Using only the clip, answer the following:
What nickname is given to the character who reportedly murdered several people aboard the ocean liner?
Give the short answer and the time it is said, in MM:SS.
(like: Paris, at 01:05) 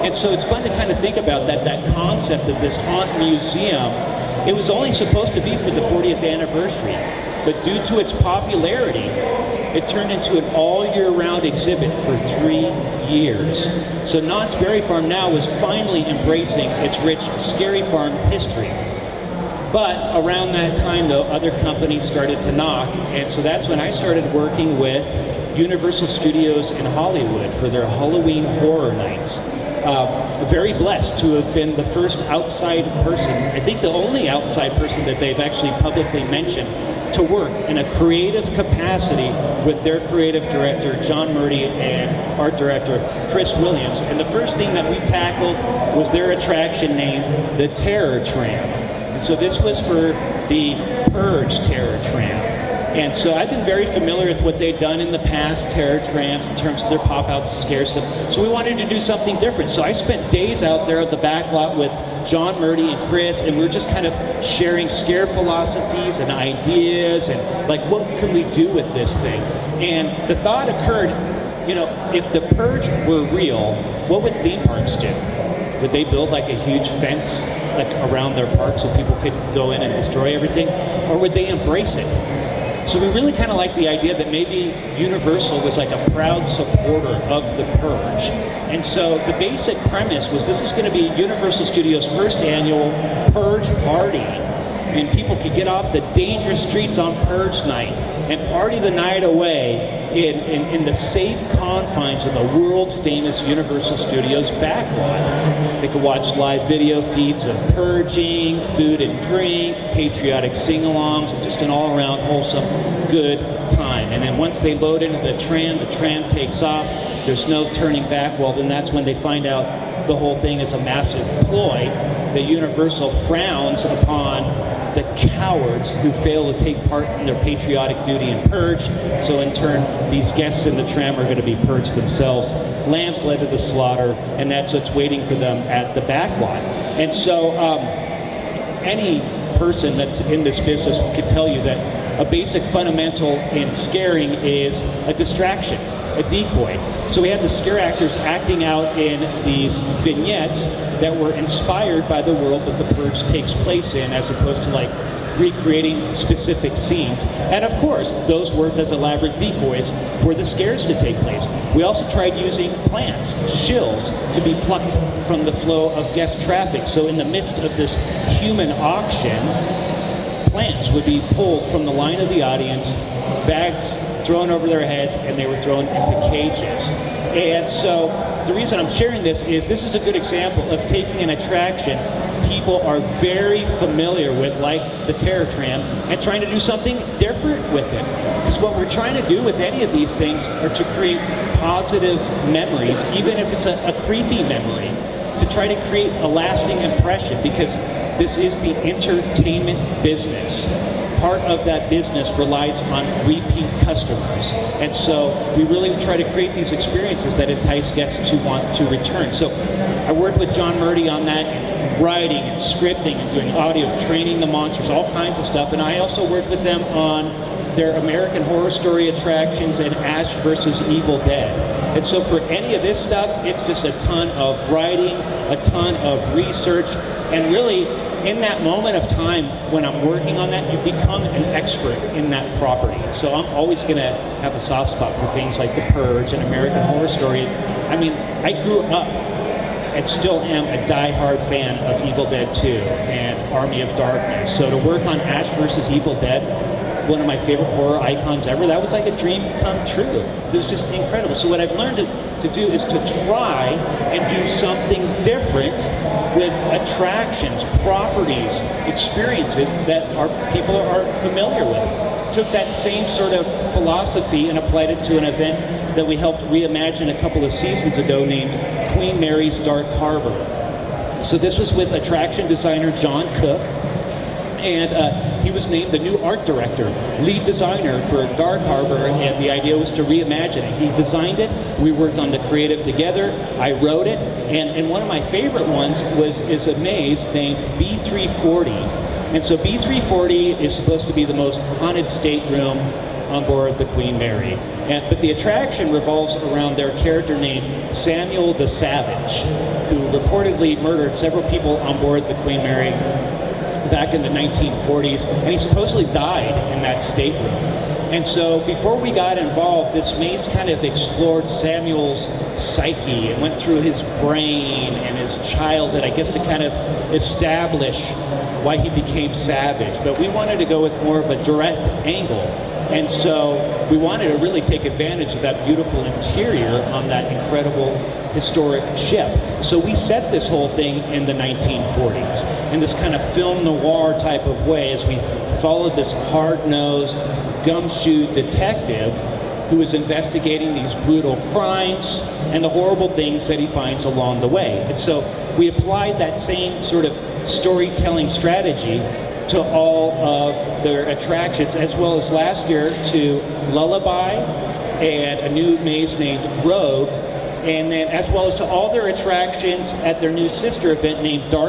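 Samuel the Savage, at 04:57.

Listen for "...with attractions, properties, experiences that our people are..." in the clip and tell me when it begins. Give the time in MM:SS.
04:16.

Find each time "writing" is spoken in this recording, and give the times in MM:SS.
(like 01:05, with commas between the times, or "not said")
03:31, 03:44.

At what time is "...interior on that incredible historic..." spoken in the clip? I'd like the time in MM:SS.
05:26.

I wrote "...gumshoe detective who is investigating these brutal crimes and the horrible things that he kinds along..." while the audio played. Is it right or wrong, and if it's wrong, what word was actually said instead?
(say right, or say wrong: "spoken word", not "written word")
wrong: "finds", not "kinds".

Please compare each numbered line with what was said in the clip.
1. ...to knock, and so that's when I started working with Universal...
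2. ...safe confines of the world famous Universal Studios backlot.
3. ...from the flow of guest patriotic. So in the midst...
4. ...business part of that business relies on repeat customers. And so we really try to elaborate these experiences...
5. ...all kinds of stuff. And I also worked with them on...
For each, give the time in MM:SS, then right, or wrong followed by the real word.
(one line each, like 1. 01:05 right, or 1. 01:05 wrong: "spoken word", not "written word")
1. 00:22 right
2. 01:40 right
3. 02:45 wrong: "traffic", not "patriotic"
4. 03:20 wrong: "create", not "elaborate"
5. 03:34 right.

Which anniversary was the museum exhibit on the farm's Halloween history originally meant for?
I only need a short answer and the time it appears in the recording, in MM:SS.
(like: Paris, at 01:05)
40th, at 00:05.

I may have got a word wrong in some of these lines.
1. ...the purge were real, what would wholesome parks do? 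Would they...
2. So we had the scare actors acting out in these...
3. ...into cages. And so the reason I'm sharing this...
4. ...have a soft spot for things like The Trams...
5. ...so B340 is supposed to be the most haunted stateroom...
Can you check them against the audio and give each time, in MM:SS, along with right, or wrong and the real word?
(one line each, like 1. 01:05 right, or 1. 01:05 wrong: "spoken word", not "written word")
1. 01:12 wrong: "theme", not "wholesome"
2. 02:27 right
3. 02:55 right
4. 03:54 wrong: "Purge", not "Trams"
5. 04:49 right.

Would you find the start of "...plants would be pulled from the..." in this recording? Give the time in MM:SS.
02:50.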